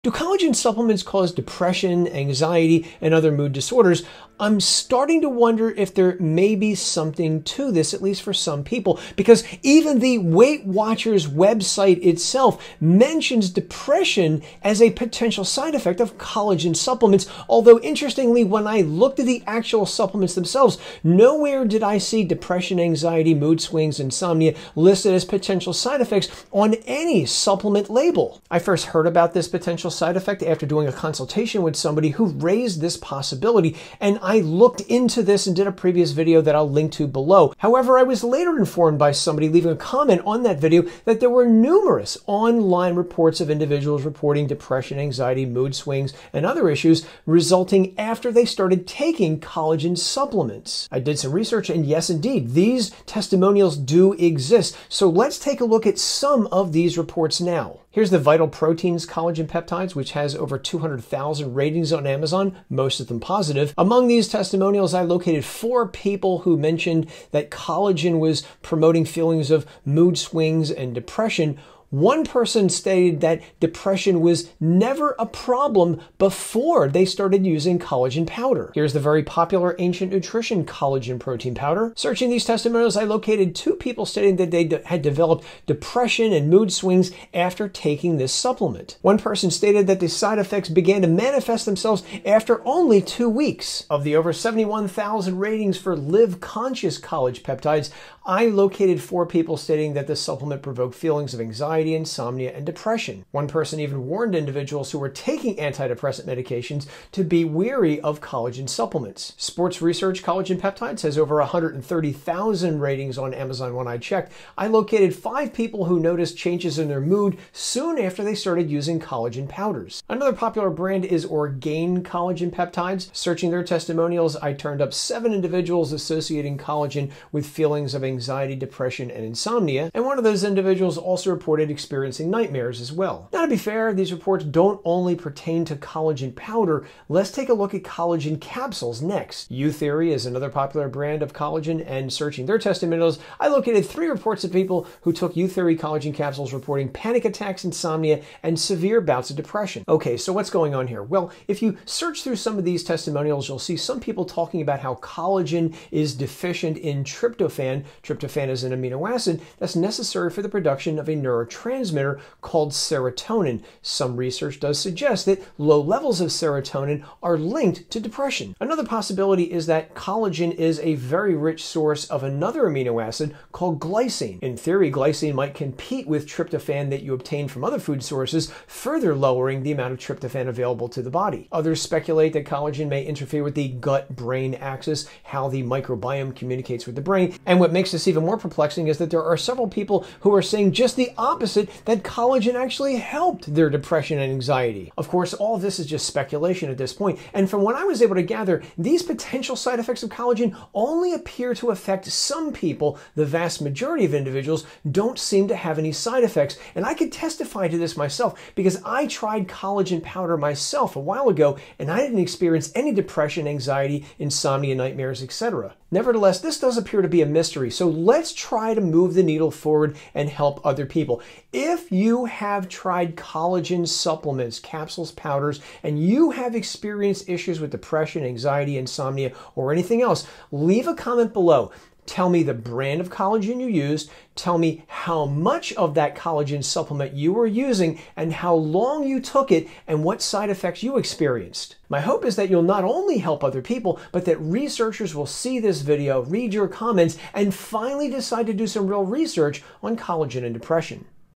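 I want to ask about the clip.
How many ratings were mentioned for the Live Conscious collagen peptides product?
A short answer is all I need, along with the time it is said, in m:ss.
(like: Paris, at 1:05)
Over 71,000, at 1:34.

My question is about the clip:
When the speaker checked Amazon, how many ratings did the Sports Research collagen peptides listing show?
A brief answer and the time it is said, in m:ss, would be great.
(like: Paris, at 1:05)
Over 130,000, at 1:51.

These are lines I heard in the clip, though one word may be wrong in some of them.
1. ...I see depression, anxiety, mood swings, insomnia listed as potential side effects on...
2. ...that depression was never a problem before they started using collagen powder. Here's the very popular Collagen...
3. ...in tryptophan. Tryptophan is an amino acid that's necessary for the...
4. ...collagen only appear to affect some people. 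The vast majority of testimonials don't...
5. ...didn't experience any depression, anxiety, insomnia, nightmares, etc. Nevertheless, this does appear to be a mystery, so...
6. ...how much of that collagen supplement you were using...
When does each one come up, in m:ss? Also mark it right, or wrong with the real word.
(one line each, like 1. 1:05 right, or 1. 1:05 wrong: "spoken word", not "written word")
1. 0:21 right
2. 1:13 wrong: "Ancient", not "Collagen"
3. 2:36 right
4. 3:20 wrong: "individuals", not "testimonials"
5. 3:31 right
6. 3:54 right.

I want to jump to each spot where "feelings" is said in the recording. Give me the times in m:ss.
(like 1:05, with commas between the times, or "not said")
1:09, 1:40, 2:07.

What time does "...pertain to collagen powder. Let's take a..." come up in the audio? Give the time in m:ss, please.
2:15.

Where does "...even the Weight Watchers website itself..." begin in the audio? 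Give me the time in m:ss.
0:09.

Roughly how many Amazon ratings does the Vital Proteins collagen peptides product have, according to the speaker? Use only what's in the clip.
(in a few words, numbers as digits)
Over 200,000.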